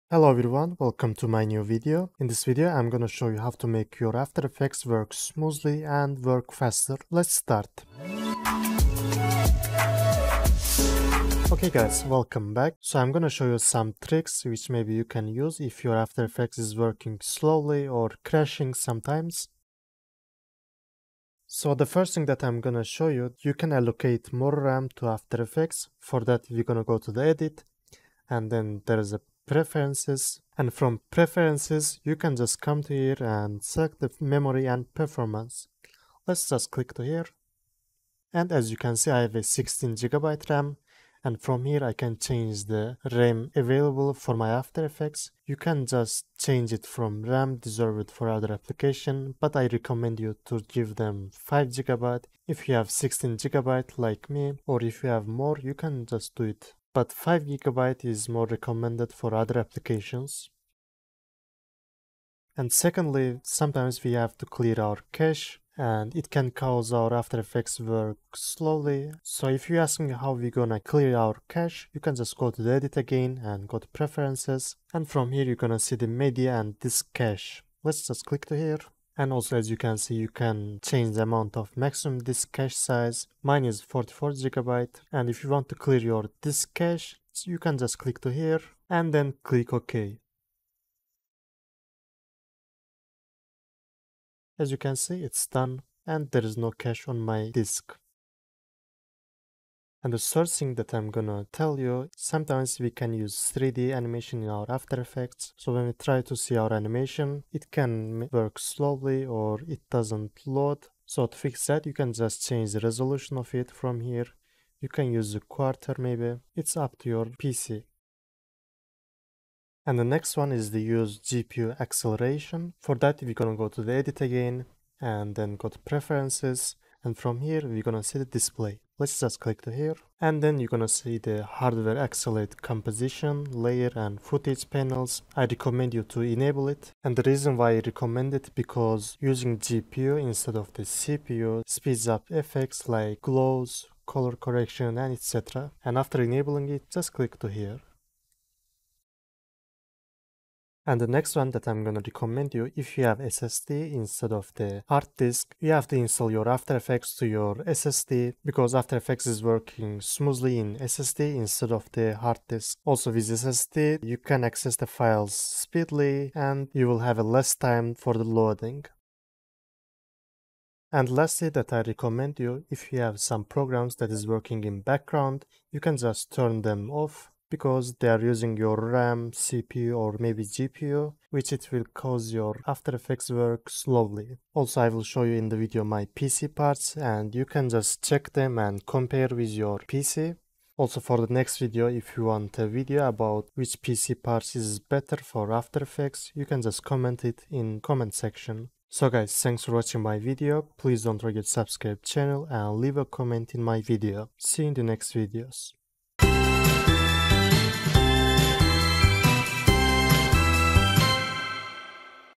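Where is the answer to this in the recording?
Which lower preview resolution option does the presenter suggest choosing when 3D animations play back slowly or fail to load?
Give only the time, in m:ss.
1:55.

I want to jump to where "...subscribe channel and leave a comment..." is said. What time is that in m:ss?
3:21.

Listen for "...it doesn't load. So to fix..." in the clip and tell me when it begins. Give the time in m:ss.
1:49.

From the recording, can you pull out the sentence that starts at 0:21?
So the first thing that I'm gonna show you, you can allocate more RAM to After Effects.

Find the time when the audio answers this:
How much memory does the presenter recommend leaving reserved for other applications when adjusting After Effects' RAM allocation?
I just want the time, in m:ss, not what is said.
0:57.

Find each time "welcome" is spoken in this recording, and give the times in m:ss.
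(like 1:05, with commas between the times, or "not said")
0:00, 0:12.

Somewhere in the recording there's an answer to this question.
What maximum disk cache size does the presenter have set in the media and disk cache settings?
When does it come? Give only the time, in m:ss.
1:23.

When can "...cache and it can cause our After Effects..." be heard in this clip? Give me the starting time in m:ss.
1:05.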